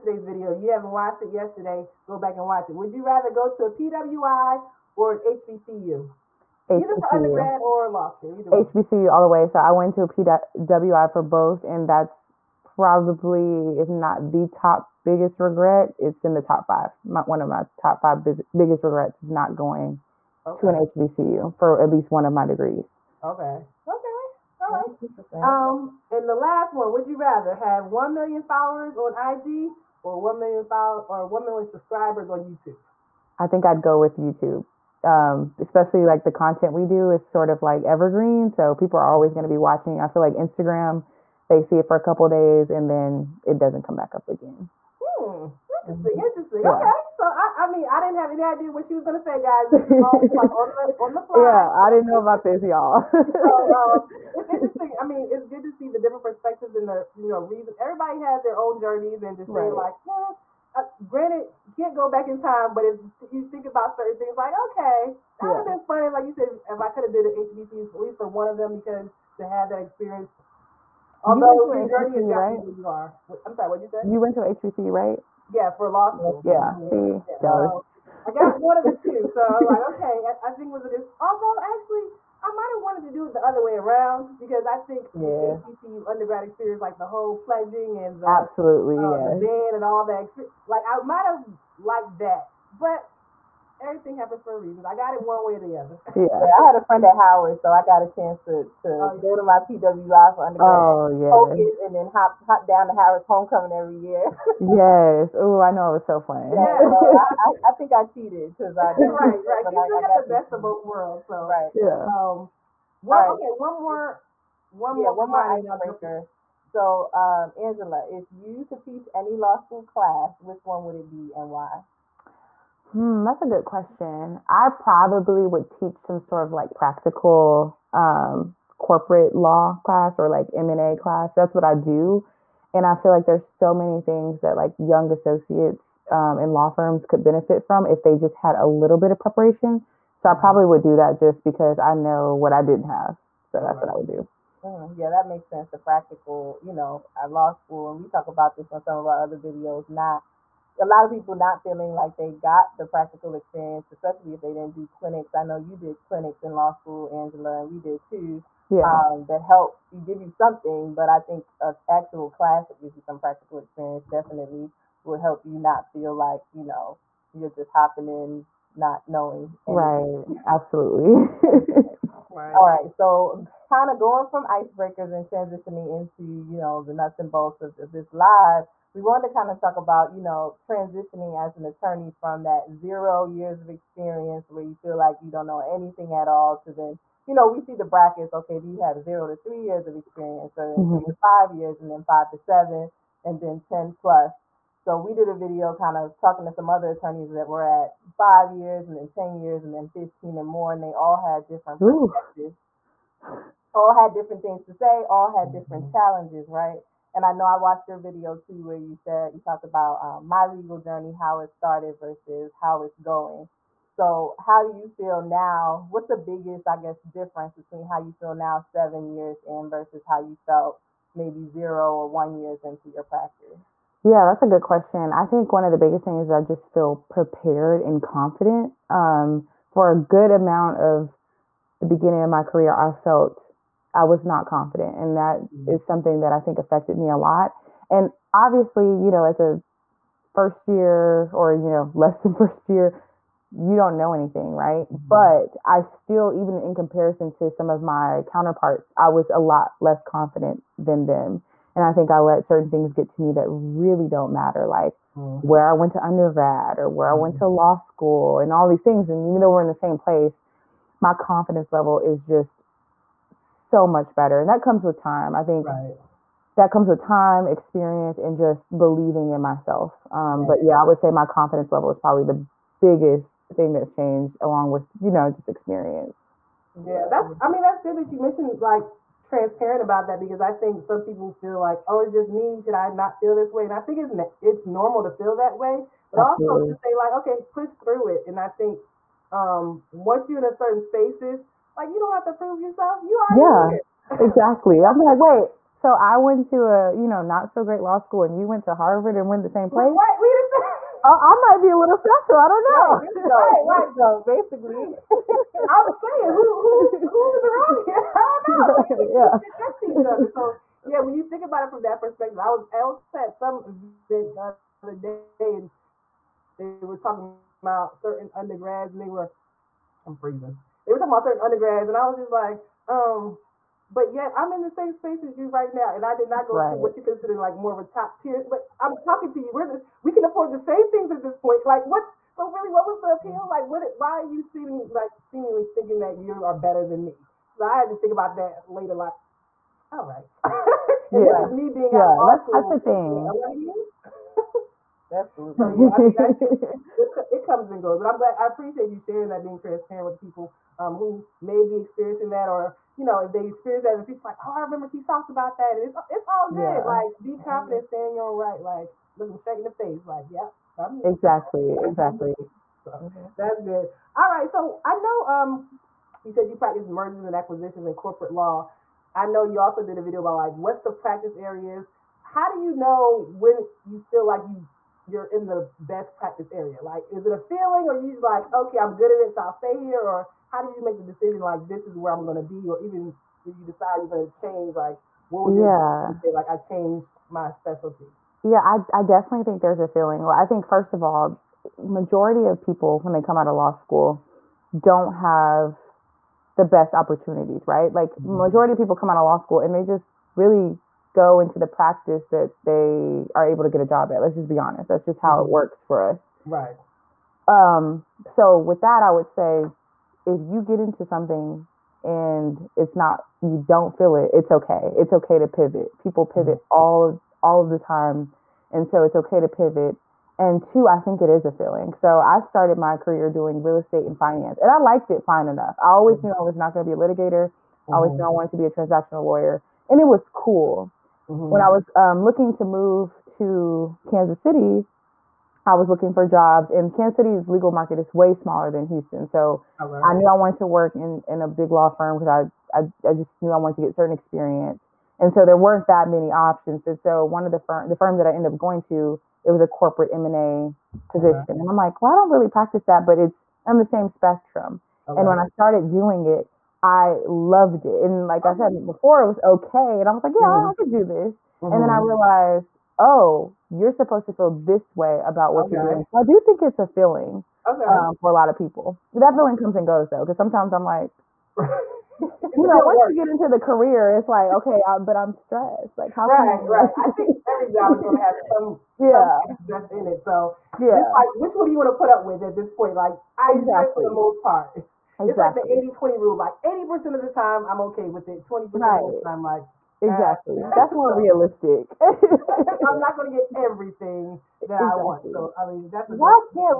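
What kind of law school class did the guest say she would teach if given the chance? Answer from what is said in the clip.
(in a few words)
M&A class.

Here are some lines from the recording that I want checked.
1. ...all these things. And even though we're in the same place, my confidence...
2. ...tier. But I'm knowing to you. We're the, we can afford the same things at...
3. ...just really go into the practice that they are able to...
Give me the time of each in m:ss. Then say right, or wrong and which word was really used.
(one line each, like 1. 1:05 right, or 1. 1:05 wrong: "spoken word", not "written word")
1. 4:18 right
2. 5:28 wrong: "talking", not "knowing"
3. 6:39 right.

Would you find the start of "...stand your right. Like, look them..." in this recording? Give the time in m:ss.
5:57.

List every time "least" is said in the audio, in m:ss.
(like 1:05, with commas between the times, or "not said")
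0:21, 1:07.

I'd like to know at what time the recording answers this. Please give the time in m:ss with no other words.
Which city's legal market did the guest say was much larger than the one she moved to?
7:18.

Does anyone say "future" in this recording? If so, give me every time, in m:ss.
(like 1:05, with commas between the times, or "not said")
5:54.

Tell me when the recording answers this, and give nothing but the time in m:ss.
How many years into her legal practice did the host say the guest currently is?
3:38.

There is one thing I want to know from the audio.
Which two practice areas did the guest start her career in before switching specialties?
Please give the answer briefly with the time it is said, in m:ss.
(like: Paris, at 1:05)
real estate and finance, at 7:03.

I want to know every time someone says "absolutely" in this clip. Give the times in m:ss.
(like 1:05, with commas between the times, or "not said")
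1:28, 2:50, 4:46.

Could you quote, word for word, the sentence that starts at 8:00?
So yeah, just like which one do you want to put up with at this point?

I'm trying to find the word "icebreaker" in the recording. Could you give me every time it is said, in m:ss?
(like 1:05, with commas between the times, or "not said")
1:55, 2:54.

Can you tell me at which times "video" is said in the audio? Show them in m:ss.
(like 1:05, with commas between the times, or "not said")
0:00, 2:29, 3:15, 3:27, 6:10.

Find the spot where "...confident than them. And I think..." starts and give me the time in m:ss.
4:10.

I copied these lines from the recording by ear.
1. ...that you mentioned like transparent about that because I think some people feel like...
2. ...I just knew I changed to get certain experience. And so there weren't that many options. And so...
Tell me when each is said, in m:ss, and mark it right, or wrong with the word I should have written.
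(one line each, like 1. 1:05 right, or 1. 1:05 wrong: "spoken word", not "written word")
1. 4:37 right
2. 7:23 wrong: "wanted", not "changed".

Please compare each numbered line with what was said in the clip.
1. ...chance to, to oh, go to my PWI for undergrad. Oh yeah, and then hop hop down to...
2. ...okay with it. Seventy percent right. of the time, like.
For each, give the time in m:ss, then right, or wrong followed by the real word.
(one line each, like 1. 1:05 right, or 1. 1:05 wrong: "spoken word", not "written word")
1. 1:38 right
2. 8:07 wrong: "Twenty", not "Seventy".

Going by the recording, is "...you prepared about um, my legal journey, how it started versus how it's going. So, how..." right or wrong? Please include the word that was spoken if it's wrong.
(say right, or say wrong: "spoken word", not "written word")
wrong: "talked", not "prepared".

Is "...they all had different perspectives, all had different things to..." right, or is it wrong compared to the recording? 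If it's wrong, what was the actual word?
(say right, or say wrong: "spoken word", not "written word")
right.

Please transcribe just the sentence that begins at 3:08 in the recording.
Okay, do you have zero to three years of experience, or then mm-hmm.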